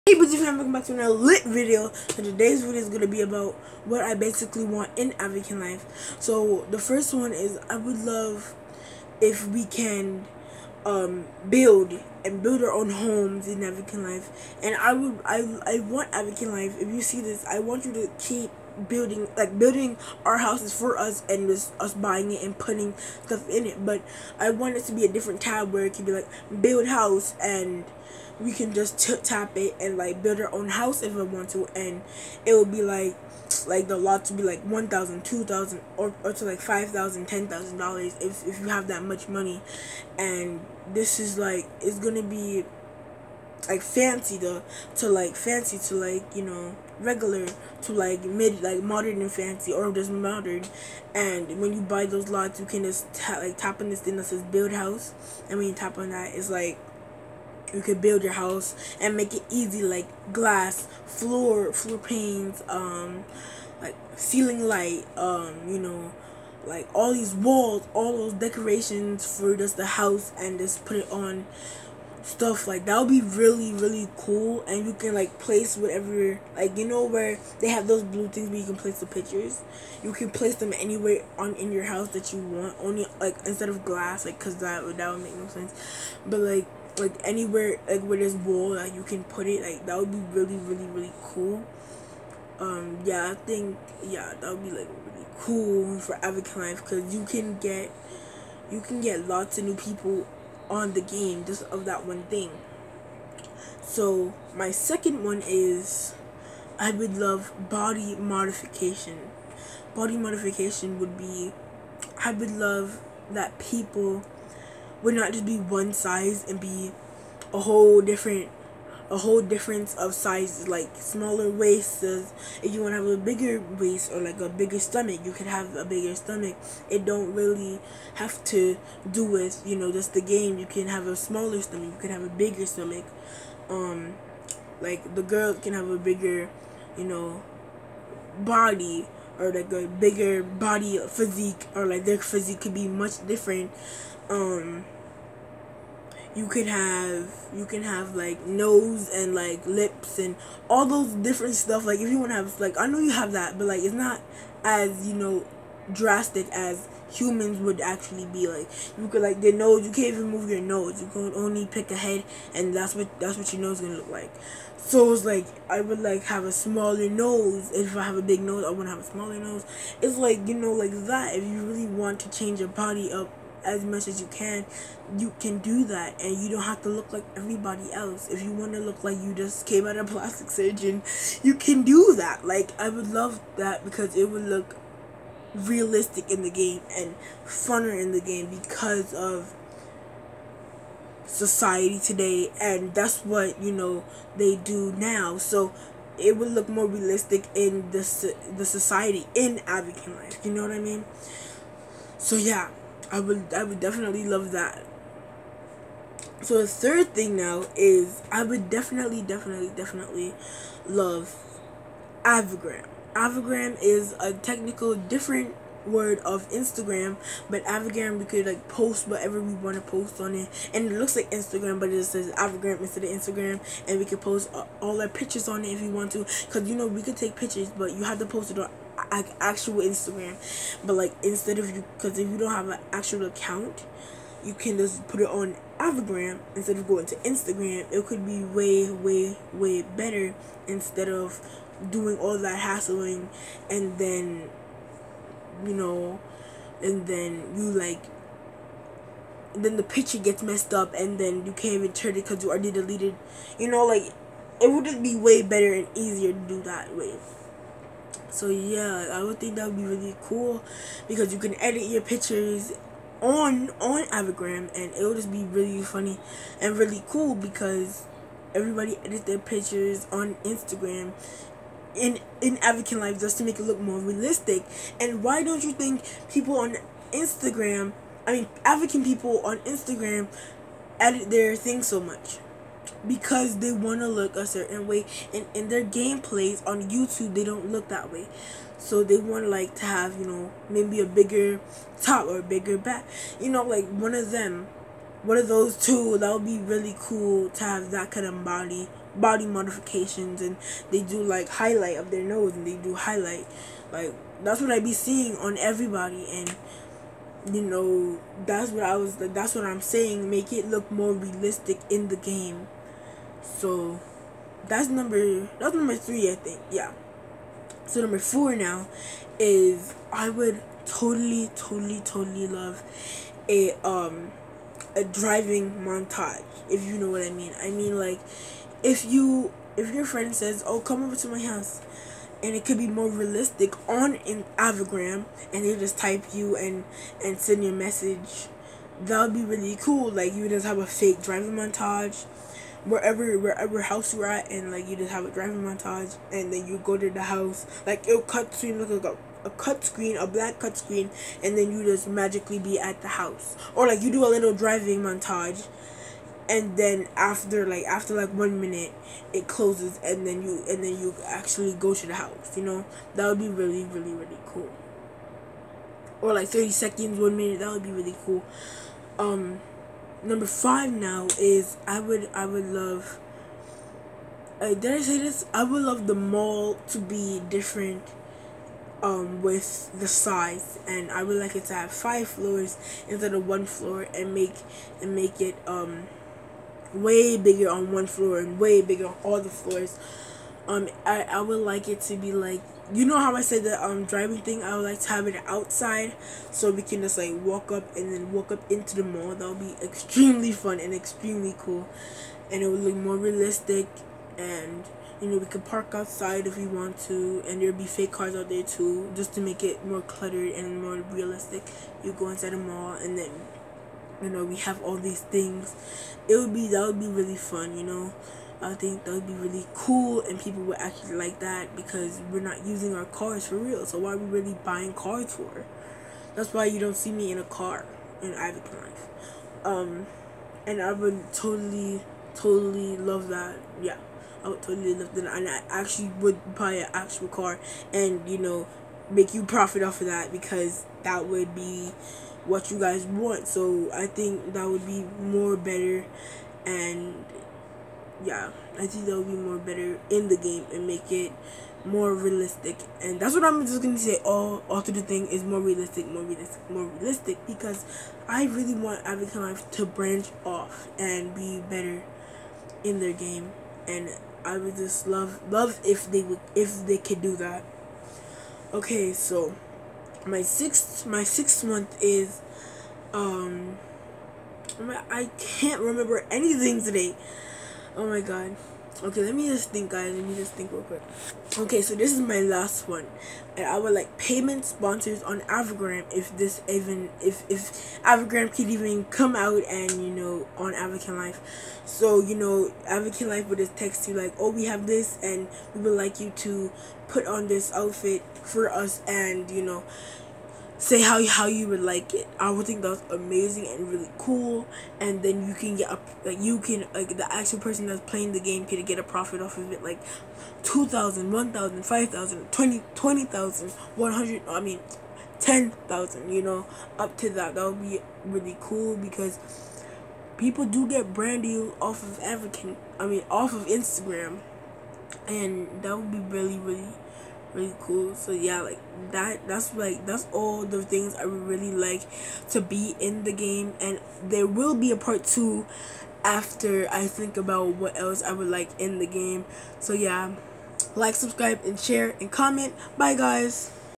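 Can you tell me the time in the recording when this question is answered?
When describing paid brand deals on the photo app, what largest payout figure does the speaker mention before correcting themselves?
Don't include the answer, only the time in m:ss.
8:32.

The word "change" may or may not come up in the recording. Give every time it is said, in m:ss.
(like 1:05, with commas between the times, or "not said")
2:52.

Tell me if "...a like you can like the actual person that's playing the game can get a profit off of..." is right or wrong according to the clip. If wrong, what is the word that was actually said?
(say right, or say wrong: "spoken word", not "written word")
right.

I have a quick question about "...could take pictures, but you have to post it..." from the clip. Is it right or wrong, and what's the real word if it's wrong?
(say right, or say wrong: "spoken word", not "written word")
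right.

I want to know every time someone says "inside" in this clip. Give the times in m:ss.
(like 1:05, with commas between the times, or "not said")
6:52.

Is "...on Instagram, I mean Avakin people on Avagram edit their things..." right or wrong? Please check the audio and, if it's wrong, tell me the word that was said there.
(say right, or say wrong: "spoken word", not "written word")
wrong: "Instagram", not "Avagram".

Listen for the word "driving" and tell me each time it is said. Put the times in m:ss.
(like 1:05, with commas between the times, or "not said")
5:25, 5:41, 5:45, 5:54, 6:34.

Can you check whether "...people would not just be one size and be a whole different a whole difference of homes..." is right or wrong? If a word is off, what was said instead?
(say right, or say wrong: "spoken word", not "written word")
wrong: "sizes", not "homes".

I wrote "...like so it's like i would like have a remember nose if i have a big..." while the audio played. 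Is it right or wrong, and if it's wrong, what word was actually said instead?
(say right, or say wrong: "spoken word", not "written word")
wrong: "smaller", not "remember".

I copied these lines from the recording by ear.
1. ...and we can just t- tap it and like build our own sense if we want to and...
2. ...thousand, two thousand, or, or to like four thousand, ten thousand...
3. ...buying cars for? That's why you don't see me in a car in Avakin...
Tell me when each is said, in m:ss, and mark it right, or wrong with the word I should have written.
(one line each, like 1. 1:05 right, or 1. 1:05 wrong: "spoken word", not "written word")
1. 0:27 wrong: "house", not "sense"
2. 0:34 wrong: "five", not "four"
3. 7:04 right.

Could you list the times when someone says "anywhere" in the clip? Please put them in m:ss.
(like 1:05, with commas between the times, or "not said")
1:20, 1:27.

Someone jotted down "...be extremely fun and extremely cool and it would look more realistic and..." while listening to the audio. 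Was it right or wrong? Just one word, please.
right.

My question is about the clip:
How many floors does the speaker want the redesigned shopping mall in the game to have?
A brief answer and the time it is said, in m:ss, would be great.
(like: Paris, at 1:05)
5, at 6:21.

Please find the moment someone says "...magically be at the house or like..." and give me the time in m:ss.
5:52.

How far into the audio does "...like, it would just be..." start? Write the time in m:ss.
4:13.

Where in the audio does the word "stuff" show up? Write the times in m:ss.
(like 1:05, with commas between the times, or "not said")
0:23, 1:12, 2:31.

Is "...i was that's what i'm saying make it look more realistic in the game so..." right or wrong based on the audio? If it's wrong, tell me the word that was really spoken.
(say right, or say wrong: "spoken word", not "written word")
right.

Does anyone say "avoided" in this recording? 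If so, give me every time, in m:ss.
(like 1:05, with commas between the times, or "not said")
not said.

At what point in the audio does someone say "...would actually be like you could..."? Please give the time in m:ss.
2:37.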